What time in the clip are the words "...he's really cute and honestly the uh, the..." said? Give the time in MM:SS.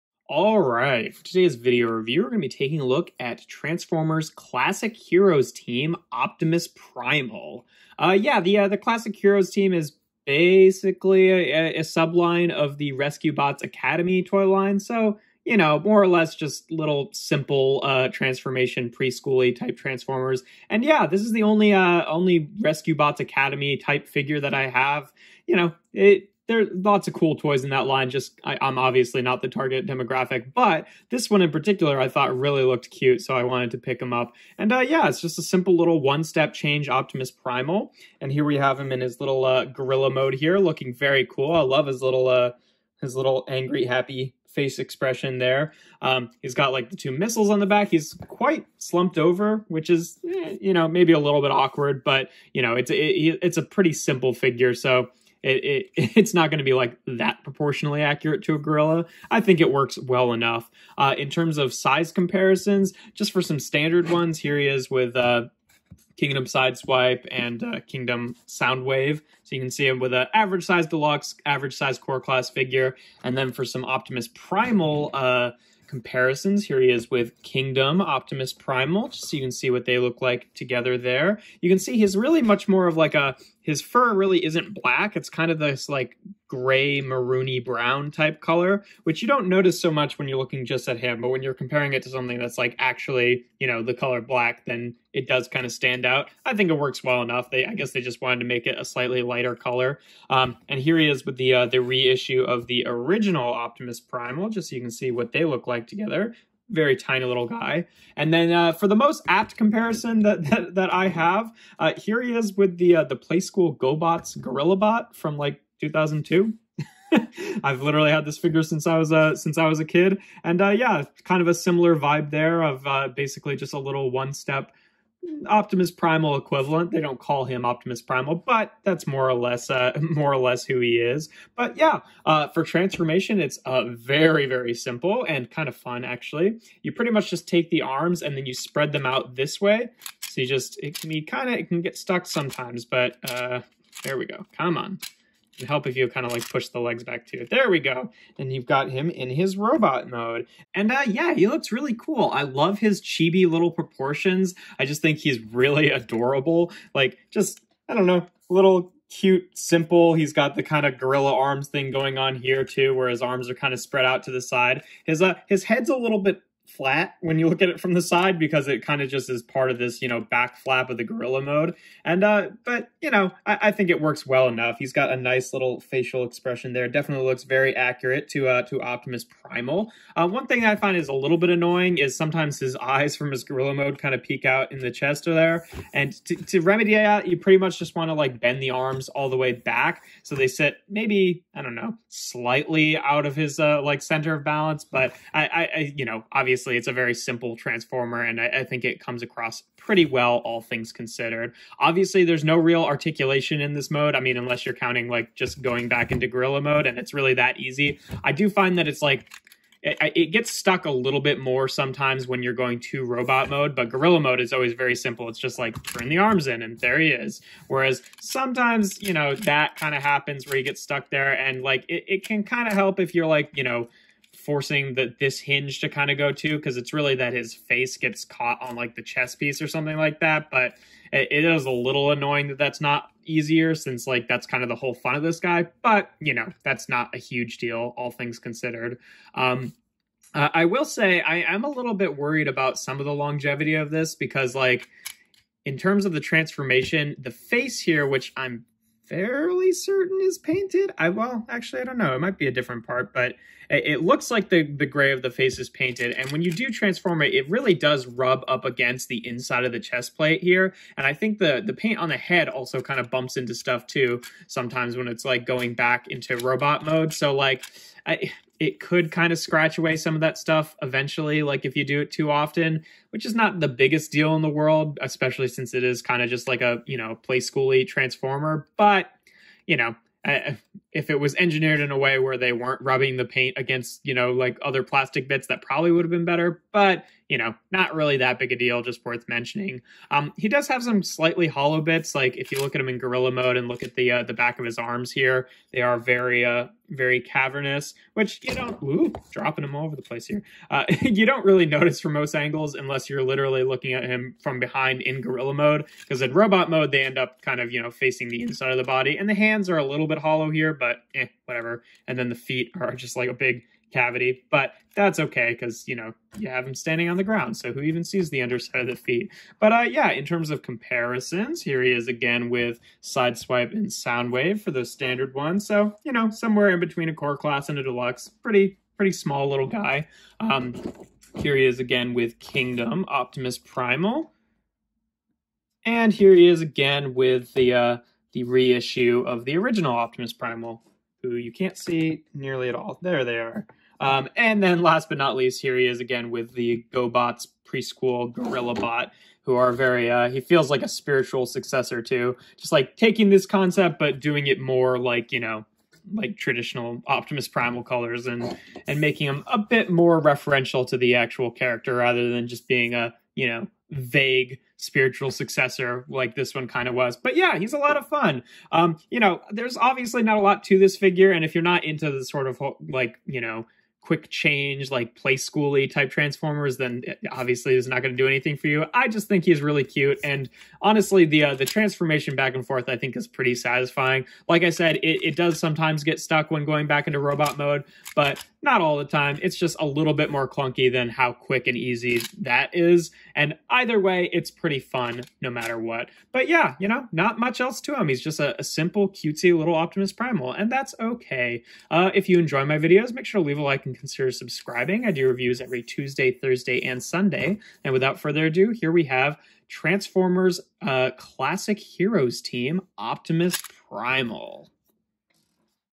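06:19.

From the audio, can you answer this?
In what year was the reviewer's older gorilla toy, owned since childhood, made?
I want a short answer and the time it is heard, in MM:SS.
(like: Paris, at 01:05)
2002, at 01:55.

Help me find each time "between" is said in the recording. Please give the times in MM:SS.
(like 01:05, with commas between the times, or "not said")
05:26.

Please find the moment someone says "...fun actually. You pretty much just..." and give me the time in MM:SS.
02:15.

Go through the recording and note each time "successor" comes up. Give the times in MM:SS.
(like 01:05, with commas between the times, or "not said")
05:51, 06:05.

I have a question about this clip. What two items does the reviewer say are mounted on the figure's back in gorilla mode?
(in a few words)
missiles.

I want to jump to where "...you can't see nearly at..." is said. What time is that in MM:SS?
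05:41.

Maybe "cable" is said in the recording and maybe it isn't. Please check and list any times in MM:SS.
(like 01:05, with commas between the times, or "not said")
not said.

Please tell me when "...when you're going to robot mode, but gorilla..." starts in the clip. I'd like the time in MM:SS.
03:32.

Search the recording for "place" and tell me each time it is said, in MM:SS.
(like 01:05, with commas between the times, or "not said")
05:00.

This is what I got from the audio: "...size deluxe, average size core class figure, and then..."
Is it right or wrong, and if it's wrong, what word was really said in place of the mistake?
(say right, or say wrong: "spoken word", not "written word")
right.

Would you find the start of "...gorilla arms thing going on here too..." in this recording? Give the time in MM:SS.
02:40.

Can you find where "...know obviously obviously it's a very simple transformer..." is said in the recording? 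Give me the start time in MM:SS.
03:16.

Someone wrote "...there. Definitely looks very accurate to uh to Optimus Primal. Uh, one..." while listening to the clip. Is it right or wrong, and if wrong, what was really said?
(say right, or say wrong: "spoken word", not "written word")
right.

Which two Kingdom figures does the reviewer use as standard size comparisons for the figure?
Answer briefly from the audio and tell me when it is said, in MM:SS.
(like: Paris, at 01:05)
Sideswipe and Soundwave, at 01:06.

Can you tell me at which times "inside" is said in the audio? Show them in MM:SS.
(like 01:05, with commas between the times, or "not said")
04:19, 05:08.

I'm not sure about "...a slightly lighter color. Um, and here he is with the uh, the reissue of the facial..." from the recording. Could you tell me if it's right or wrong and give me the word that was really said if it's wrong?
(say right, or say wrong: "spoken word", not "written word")
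wrong: "original", not "facial".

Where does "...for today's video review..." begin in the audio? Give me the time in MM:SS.
00:01.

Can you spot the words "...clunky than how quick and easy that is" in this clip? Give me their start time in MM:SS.
06:30.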